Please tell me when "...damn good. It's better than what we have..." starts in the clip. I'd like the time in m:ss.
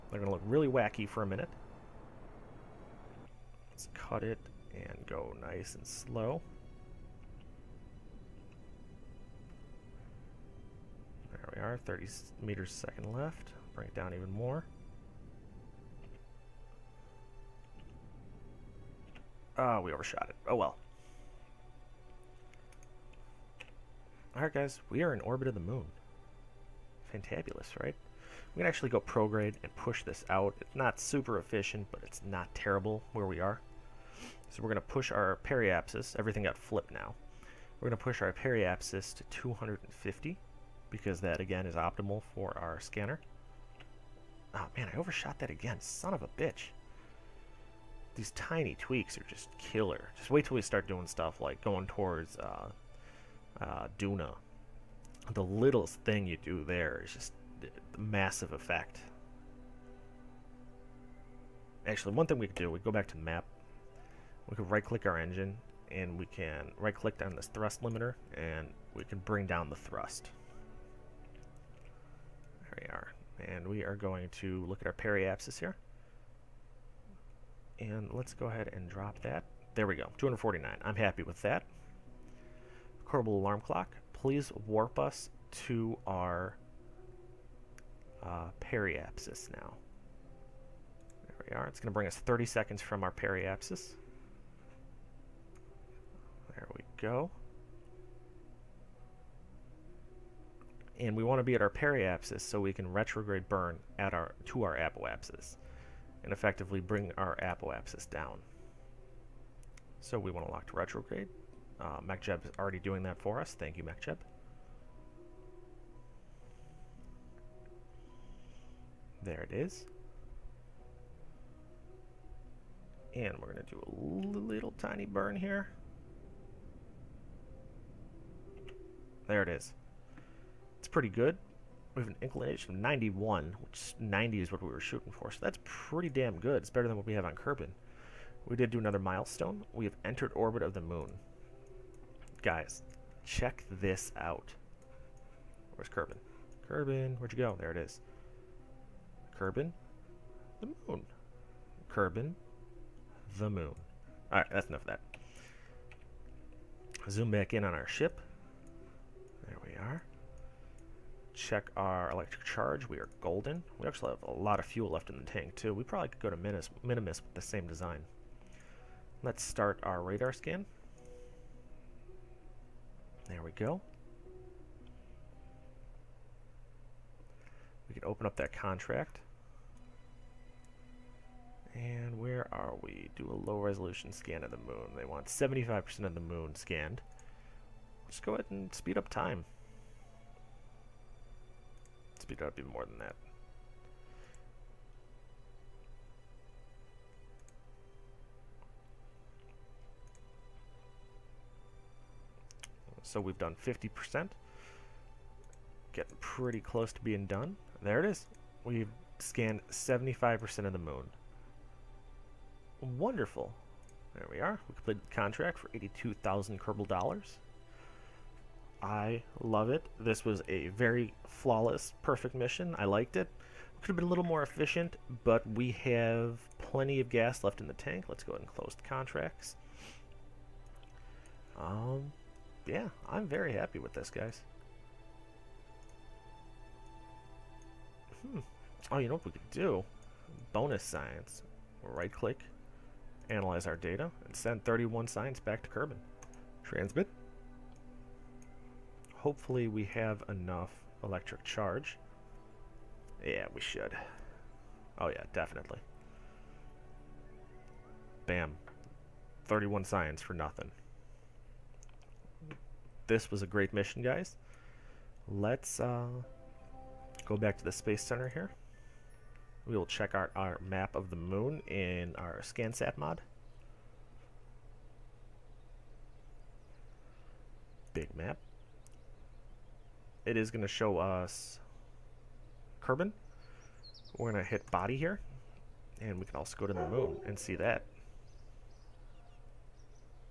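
2:16.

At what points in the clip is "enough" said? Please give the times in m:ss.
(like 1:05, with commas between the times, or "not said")
2:34, 4:10.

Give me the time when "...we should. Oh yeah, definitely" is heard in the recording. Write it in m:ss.
4:13.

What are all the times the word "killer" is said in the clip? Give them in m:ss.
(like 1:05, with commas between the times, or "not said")
0:49.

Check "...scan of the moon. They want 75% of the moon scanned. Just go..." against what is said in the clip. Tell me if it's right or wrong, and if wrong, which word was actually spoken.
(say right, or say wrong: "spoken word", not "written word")
right.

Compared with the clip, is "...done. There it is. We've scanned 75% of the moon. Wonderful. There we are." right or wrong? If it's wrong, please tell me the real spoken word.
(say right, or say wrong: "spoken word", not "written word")
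right.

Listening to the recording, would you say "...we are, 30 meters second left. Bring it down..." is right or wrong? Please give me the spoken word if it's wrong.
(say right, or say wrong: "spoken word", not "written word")
right.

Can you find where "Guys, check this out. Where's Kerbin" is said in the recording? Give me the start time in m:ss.
2:22.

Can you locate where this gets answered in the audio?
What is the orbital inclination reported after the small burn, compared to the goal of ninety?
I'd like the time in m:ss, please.
2:12.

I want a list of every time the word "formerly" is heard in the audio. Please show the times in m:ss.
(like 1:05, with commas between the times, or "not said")
not said.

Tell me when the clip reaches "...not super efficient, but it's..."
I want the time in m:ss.
0:30.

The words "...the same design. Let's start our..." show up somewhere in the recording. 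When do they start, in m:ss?
2:47.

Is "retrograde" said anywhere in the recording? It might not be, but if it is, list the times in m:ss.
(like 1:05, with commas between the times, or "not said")
1:42, 1:50.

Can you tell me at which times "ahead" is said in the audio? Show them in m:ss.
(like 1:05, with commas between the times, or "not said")
1:18, 3:08, 3:48.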